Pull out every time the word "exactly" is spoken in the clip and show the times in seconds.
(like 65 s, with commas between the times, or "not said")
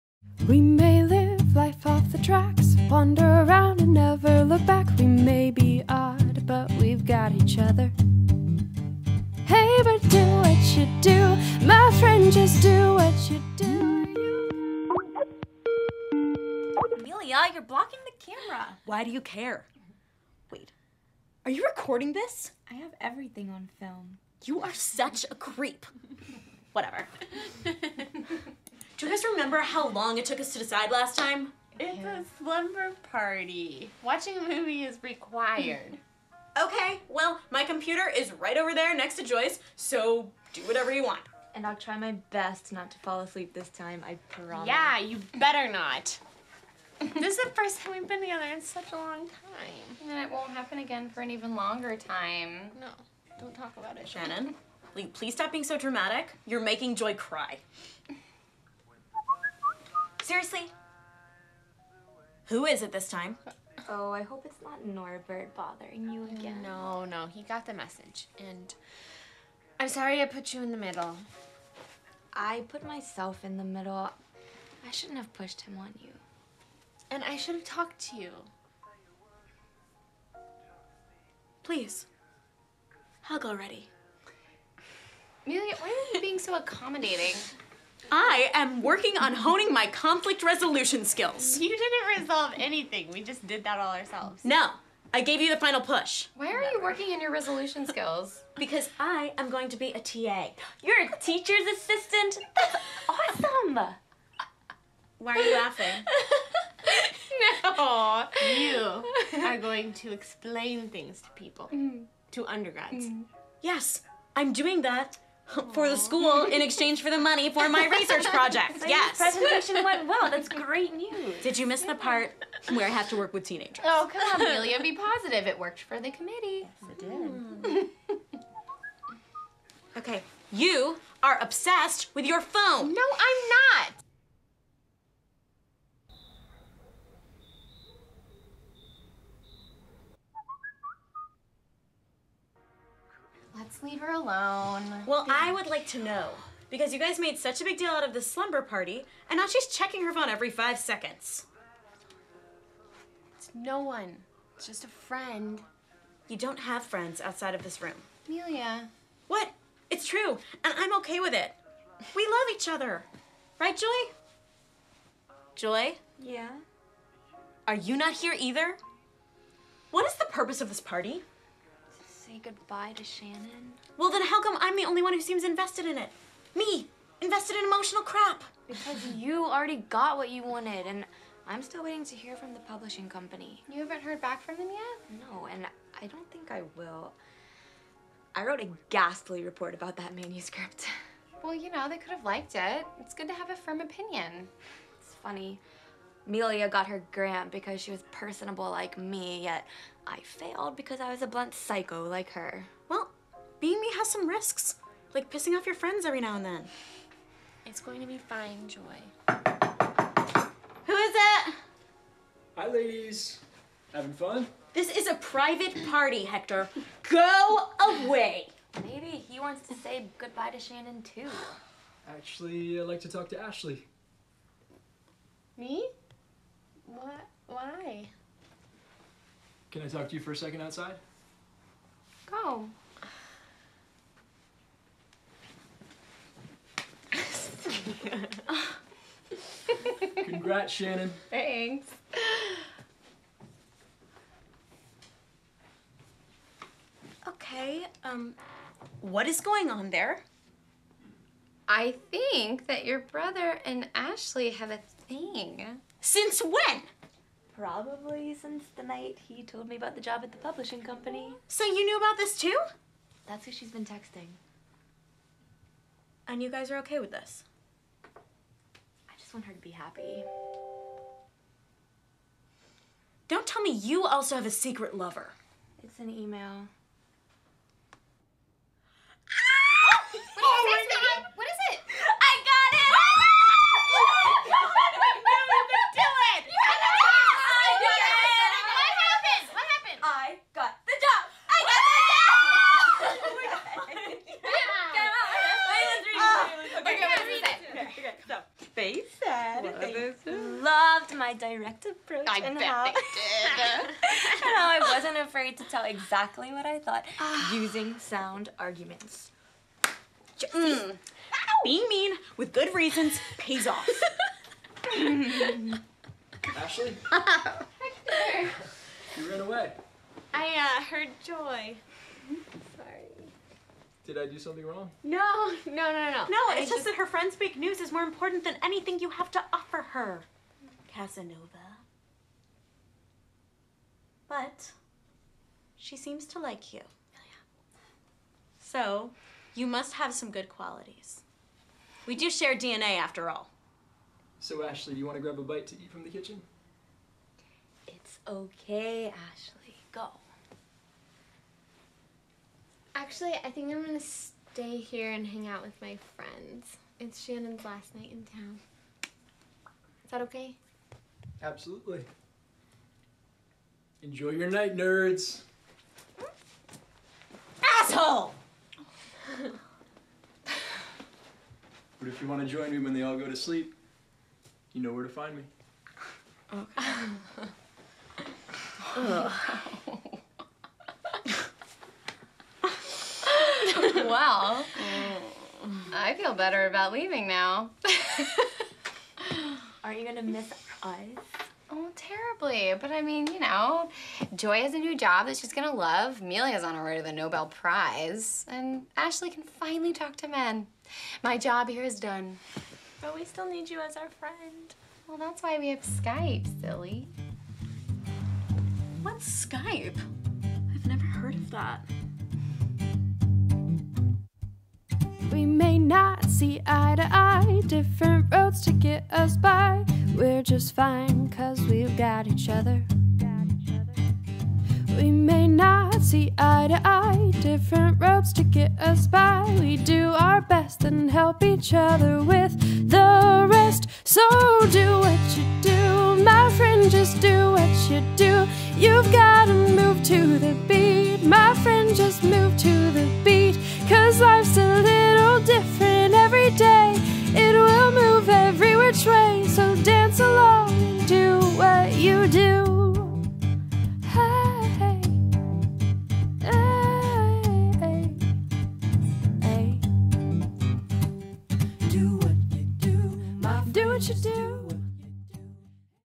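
305 s.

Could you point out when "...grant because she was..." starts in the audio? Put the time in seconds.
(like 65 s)
197 s.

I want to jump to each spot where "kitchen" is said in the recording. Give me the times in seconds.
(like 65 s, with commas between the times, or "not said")
346 s.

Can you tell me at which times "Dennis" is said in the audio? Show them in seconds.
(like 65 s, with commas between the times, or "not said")
not said.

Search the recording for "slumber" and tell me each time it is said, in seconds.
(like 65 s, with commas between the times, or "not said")
32 s, 148 s.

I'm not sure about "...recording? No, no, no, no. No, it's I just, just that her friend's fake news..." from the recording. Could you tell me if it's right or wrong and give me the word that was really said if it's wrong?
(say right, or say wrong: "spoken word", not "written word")
wrong: "wrong", not "recording".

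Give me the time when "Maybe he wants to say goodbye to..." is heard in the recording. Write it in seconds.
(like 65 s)
218 s.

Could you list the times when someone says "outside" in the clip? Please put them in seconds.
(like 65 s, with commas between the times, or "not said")
157 s, 230 s.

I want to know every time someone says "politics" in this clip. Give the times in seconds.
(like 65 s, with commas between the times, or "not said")
not said.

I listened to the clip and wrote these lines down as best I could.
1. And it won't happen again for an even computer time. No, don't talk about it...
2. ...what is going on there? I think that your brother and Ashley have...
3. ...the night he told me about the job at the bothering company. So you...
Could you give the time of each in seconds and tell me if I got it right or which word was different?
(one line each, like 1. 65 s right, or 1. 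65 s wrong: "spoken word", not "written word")
1. 50 s wrong: "longer", not "computer"
2. 248 s right
3. 258 s wrong: "publishing", not "bothering".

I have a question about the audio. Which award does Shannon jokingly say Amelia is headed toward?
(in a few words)
Nobel Prize.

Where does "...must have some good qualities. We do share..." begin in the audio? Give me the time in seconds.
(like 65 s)
339 s.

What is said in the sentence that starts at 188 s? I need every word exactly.
I wrote a ghastly report about that manuscript.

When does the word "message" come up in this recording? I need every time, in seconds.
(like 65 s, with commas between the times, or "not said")
67 s.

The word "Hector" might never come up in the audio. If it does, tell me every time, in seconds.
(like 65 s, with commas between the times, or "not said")
216 s, 317 s.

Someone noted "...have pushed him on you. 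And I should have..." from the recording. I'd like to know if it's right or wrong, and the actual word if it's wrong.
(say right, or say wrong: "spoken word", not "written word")
right.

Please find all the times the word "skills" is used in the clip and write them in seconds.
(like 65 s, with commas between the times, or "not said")
91 s, 97 s.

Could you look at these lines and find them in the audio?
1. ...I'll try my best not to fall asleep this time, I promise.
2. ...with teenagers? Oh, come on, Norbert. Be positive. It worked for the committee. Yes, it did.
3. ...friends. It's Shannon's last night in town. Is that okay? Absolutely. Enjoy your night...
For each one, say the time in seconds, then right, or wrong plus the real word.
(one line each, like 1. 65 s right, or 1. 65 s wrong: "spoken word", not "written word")
1. 41 s right
2. 123 s wrong: "Amelia", not "Norbert"
3. 356 s right.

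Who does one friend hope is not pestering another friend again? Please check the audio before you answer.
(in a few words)
Norbert.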